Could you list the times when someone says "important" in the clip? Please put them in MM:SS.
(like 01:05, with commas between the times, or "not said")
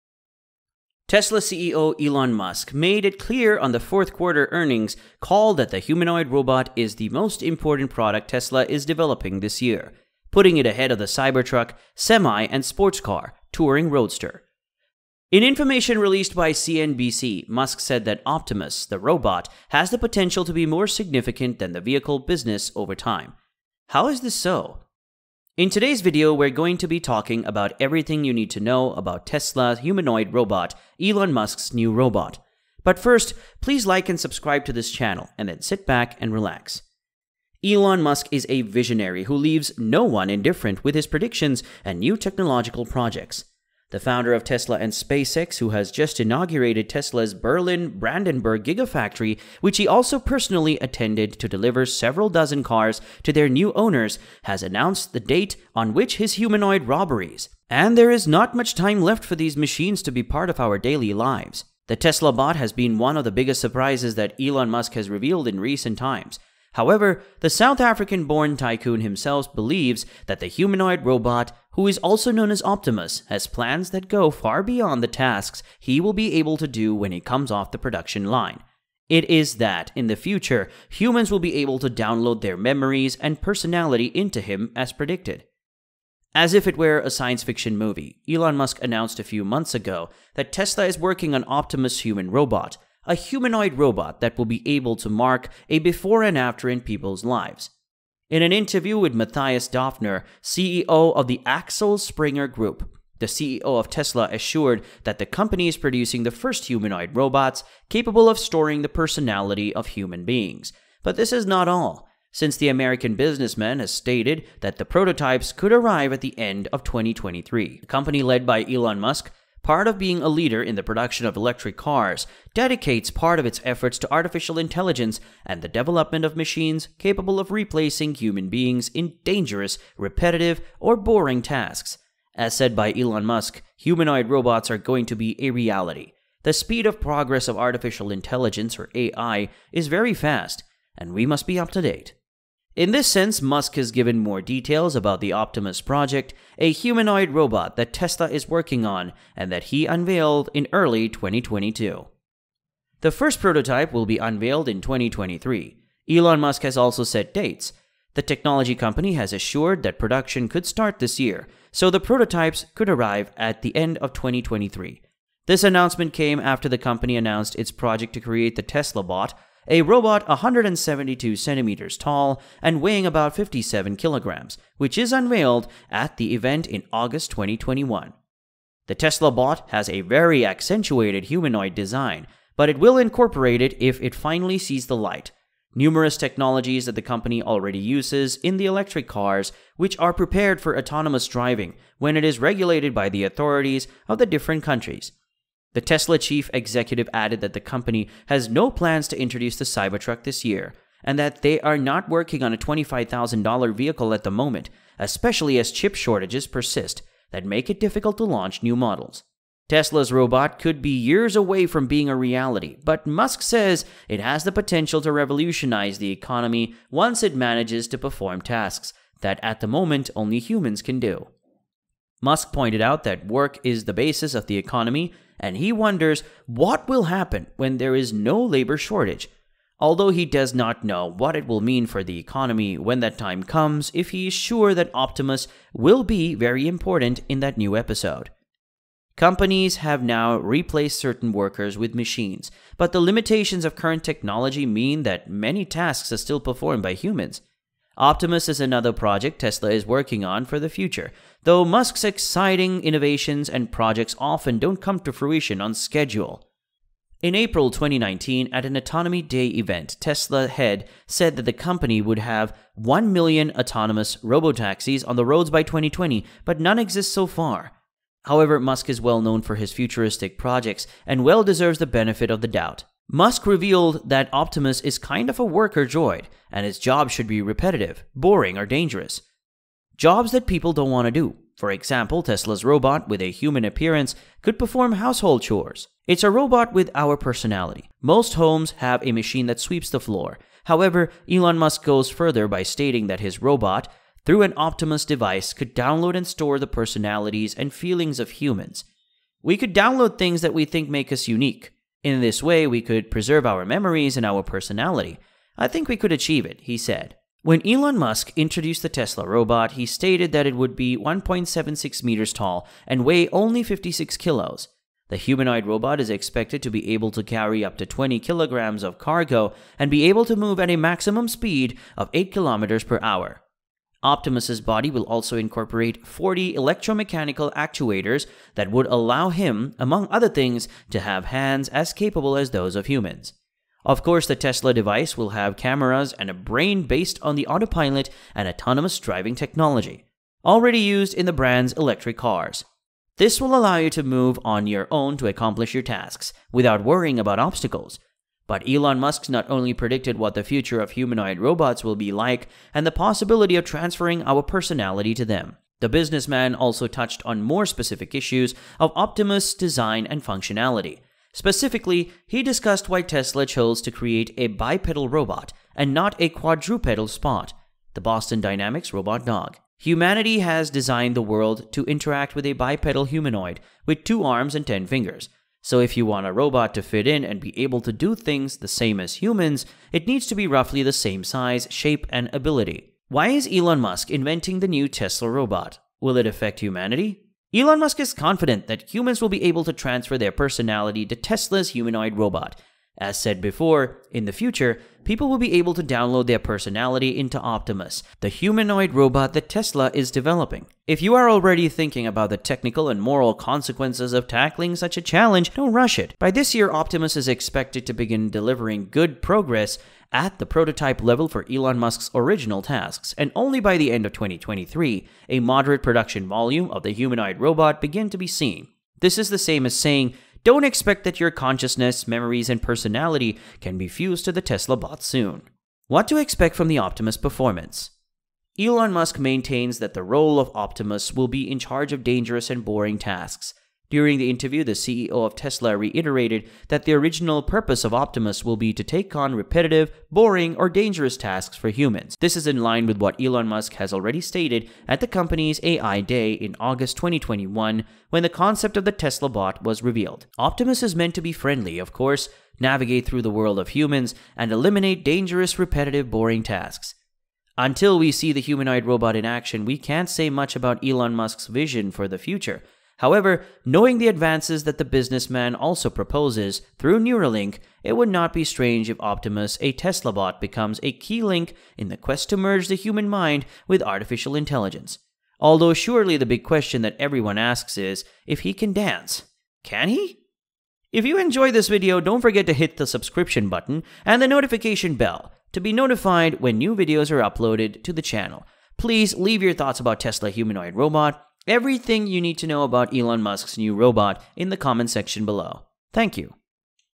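00:07, 03:56.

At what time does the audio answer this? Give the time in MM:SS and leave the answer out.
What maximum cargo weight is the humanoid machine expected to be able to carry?
05:17.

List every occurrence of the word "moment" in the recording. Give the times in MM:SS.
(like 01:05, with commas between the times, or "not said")
03:24, 03:39.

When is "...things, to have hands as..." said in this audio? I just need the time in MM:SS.
05:30.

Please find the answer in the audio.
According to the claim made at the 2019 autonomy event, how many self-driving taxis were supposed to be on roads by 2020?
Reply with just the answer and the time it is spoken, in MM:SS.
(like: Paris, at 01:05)
1 million, at 04:22.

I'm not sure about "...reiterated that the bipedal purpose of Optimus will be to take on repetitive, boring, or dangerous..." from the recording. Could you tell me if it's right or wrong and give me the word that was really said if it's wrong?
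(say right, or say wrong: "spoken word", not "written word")
wrong: "original", not "bipedal".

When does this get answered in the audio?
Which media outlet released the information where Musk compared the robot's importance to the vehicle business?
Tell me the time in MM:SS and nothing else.
00:16.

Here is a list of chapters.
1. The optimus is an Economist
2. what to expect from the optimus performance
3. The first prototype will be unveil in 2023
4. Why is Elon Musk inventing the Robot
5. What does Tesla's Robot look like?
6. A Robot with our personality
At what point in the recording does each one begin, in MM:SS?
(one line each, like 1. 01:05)
1. 04:33
2. 07:06
3. 02:35
4. 06:24
5. 05:07
6. 04:47.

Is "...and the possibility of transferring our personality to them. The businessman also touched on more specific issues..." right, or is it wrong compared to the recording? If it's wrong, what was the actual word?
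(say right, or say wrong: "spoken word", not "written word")
right.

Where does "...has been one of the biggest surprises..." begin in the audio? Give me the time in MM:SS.
01:02.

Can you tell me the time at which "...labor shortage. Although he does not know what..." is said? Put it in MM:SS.
03:48.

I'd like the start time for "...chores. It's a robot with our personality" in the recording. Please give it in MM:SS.
04:45.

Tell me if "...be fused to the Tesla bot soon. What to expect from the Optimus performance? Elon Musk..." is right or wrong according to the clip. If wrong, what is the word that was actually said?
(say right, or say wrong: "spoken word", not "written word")
right.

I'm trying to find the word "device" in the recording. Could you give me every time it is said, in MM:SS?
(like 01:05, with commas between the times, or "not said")
04:55, 05:34.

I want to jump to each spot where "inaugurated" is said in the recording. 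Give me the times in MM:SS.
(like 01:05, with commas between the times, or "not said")
00:46.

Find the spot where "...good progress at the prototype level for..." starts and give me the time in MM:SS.
06:48.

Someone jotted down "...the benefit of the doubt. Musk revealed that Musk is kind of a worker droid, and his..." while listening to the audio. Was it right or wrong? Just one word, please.
wrong.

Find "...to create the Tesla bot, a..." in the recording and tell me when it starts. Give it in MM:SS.
02:48.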